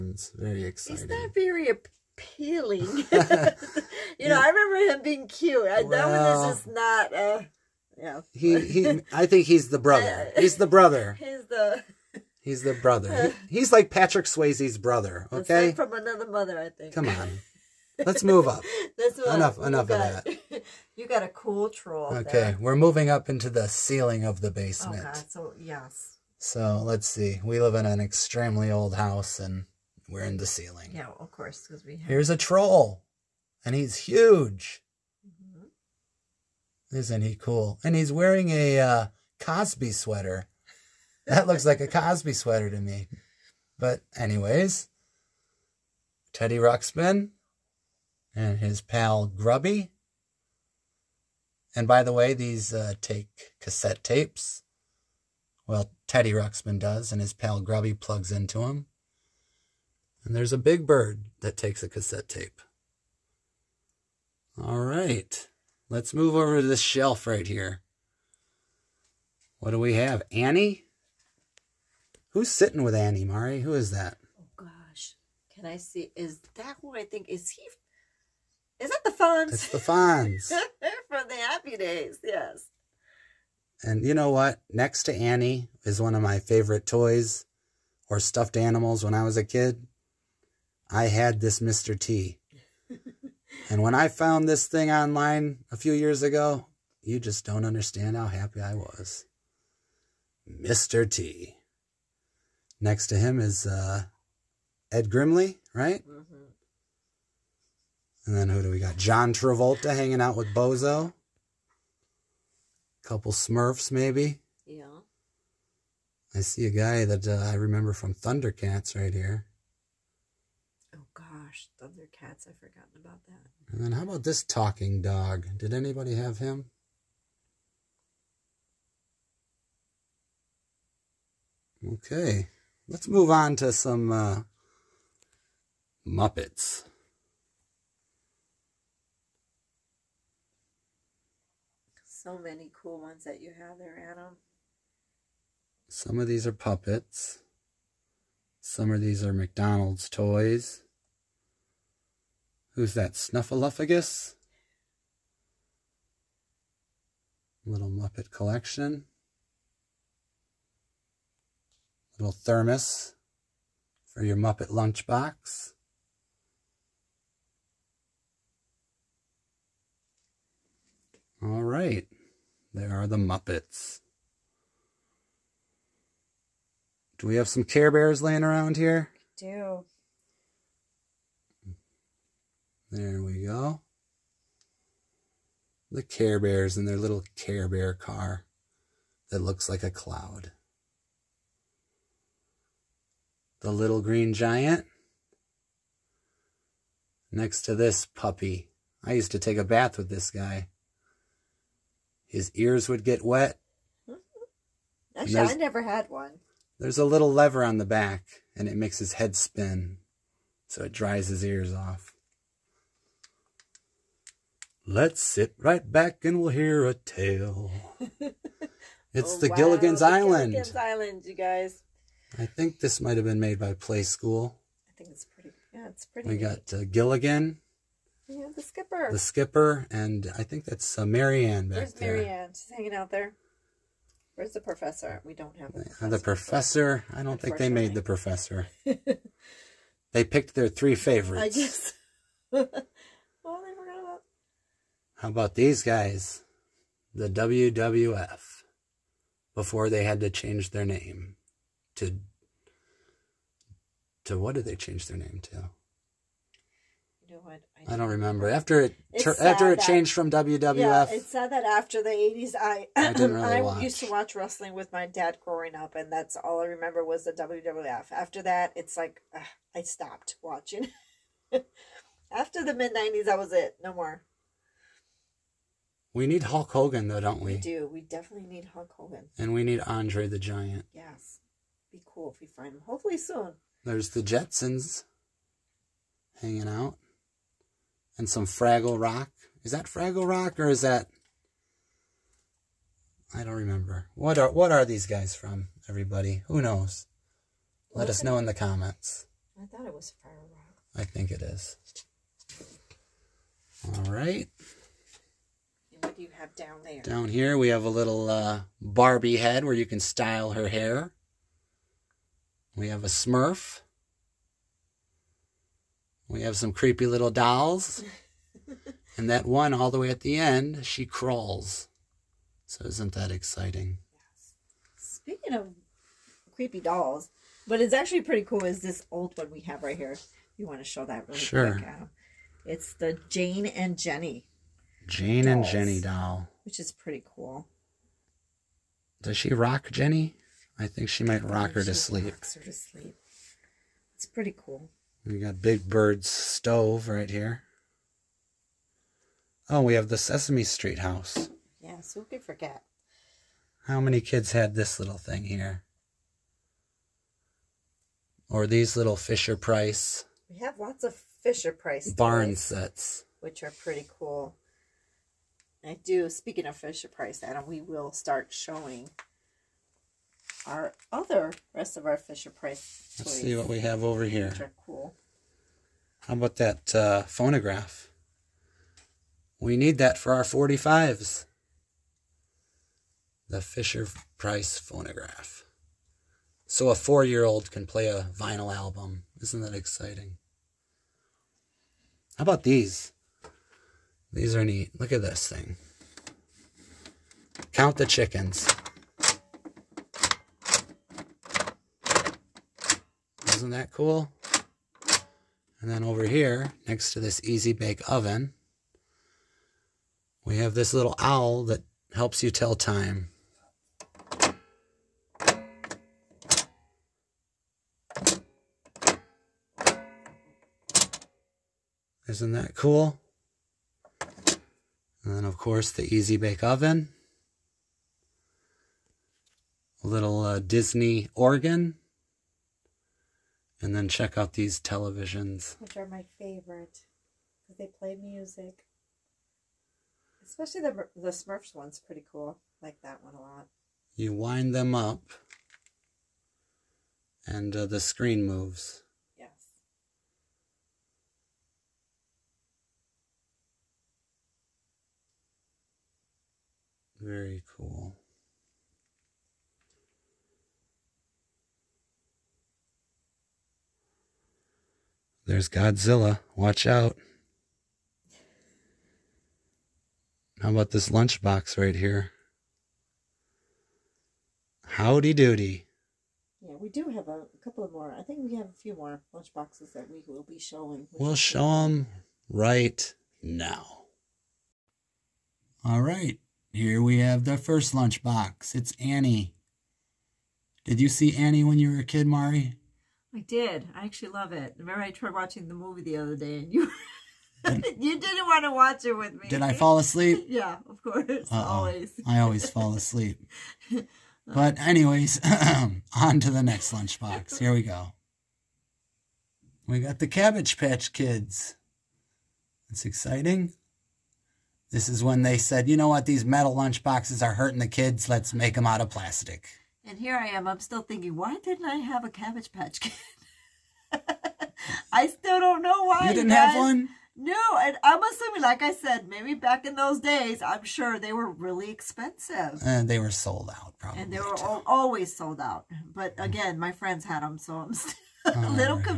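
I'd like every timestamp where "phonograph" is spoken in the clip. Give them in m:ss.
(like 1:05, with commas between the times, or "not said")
6:17, 6:24.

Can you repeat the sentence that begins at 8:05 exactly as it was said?
All right, here we have the first lunchbox.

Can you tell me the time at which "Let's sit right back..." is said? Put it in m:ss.
3:34.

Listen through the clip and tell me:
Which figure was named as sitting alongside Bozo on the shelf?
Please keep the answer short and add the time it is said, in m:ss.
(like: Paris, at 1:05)
John Travolta, at 1:48.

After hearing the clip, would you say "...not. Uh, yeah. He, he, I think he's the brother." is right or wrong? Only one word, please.
right.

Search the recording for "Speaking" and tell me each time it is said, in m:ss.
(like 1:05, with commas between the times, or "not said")
5:24, 6:06.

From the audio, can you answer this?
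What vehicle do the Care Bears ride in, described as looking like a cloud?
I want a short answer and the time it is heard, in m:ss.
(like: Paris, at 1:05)
Care Bear car, at 3:07.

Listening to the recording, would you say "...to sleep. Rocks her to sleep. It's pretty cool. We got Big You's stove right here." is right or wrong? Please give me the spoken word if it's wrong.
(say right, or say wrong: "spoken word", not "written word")
wrong: "Bird", not "You".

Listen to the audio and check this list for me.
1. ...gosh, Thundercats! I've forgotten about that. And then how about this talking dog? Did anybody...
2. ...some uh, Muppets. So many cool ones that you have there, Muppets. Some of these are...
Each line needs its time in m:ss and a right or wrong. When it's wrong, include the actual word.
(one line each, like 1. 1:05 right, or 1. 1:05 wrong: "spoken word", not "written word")
1. 2:01 right
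2. 2:13 wrong: "Adam", not "Muppets".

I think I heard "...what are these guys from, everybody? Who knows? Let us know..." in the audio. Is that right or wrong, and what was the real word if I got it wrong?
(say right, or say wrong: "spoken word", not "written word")
right.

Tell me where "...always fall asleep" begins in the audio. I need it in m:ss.
8:22.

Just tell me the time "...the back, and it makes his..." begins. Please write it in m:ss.
3:27.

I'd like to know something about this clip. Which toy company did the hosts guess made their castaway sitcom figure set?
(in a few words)
Playskool.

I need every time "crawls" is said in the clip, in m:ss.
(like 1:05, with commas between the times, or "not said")
5:21.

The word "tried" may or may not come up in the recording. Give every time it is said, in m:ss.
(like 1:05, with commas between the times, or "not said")
8:15.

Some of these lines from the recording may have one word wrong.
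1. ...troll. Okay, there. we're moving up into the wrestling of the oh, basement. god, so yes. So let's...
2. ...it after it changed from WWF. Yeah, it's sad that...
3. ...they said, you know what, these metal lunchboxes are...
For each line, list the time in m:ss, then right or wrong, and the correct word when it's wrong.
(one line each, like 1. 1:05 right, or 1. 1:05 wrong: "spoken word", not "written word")
1. 0:21 wrong: "ceiling", not "wrestling"
2. 4:18 right
3. 8:35 right.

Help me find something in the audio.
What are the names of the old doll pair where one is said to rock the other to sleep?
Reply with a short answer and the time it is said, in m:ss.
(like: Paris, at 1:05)
Jane and Jenny, at 5:33.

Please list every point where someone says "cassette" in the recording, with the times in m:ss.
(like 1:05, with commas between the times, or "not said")
0:53, 1:01.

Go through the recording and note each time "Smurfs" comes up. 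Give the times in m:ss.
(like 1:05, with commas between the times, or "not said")
1:53, 5:13, 7:21.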